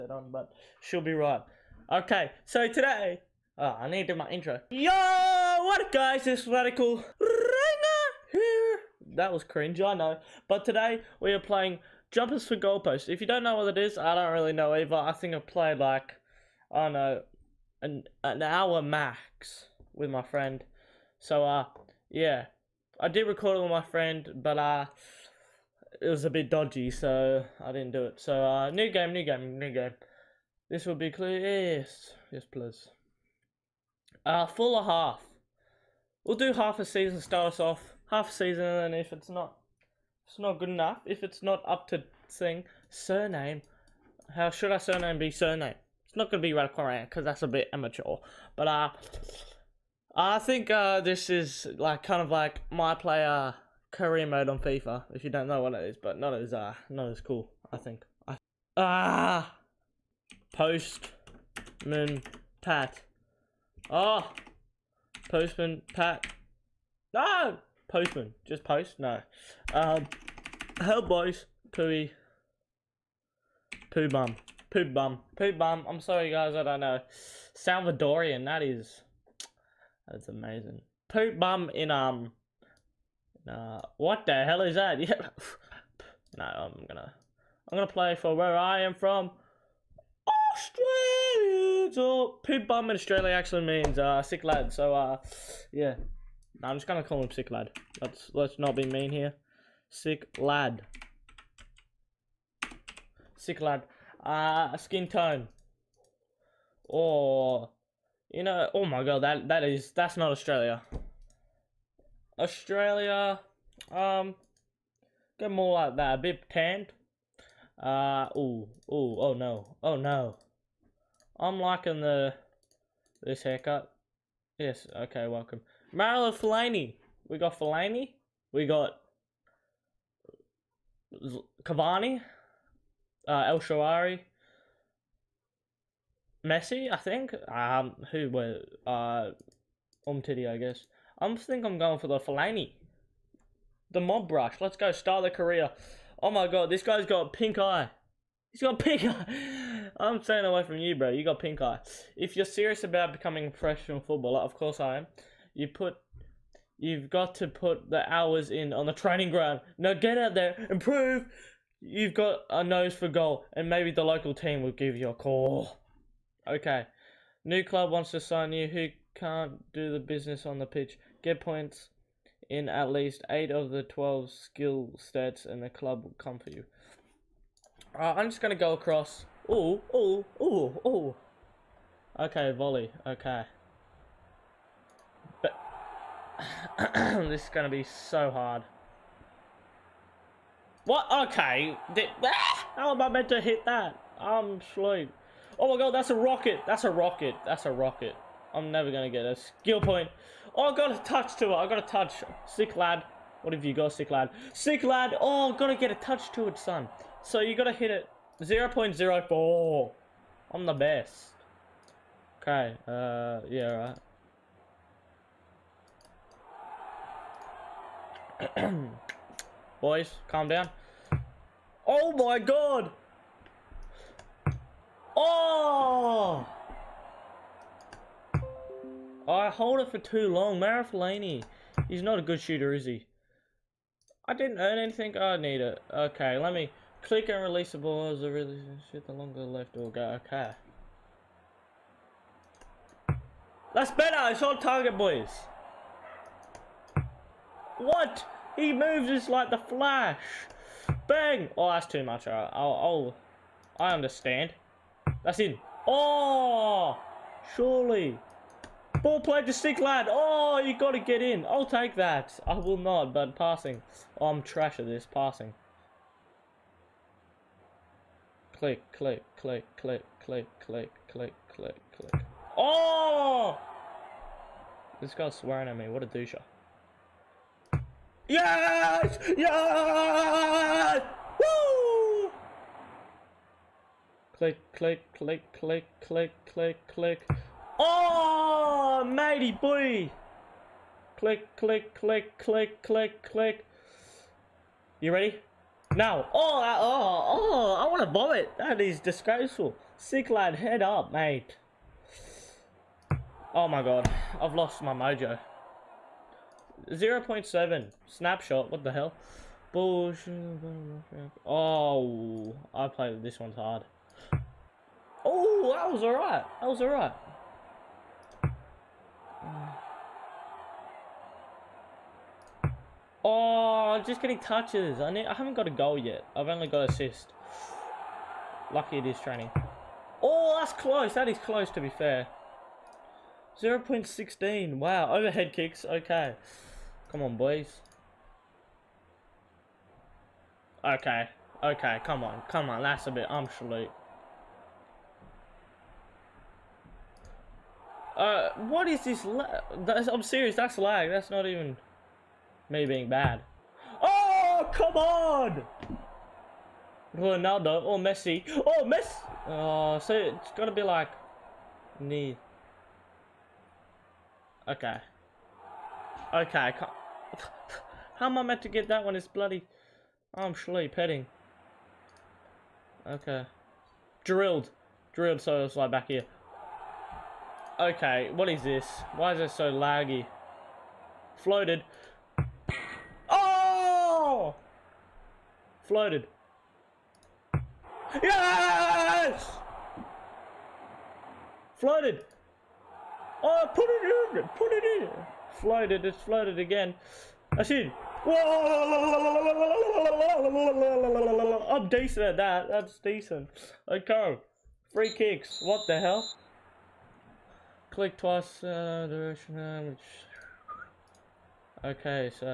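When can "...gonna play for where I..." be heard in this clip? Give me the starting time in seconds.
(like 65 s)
87 s.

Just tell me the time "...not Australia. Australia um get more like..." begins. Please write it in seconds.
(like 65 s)
110 s.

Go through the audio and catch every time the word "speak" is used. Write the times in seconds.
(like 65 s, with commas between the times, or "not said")
not said.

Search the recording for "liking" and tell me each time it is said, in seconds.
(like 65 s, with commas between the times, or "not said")
121 s.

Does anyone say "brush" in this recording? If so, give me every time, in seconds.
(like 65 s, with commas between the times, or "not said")
144 s.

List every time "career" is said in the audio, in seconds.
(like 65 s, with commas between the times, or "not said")
53 s, 145 s.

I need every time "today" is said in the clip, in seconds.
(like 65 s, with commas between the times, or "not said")
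2 s, 10 s.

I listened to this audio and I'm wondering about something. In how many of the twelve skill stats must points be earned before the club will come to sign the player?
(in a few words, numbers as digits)
8.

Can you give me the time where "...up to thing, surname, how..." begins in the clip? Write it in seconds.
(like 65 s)
41 s.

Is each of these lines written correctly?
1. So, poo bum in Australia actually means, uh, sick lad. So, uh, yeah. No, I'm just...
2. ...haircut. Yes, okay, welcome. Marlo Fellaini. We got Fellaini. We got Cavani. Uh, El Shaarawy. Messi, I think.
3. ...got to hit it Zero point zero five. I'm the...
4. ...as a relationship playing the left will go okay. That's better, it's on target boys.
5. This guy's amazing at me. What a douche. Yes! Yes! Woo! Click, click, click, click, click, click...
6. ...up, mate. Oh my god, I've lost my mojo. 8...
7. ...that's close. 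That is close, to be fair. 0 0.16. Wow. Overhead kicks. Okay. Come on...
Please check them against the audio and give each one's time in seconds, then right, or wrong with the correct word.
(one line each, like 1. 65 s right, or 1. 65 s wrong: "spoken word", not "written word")
1. 91 s right
2. 123 s right
3. 207 s wrong: "four", not "five"
4. 238 s wrong: "along", not "playing"
5. 275 s wrong: "swearing", not "amazing"
6. 300 s wrong: "0", not "8"
7. 330 s right.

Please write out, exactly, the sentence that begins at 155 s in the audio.
You put, you've got to put the hours in on the training ground.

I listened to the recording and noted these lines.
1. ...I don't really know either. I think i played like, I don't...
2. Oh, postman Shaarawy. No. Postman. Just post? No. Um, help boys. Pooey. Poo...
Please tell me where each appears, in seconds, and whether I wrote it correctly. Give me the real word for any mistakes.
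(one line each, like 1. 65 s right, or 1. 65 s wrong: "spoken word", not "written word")
1. 13 s right
2. 63 s wrong: "Pat", not "Shaarawy".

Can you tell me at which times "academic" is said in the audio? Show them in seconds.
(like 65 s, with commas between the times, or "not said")
not said.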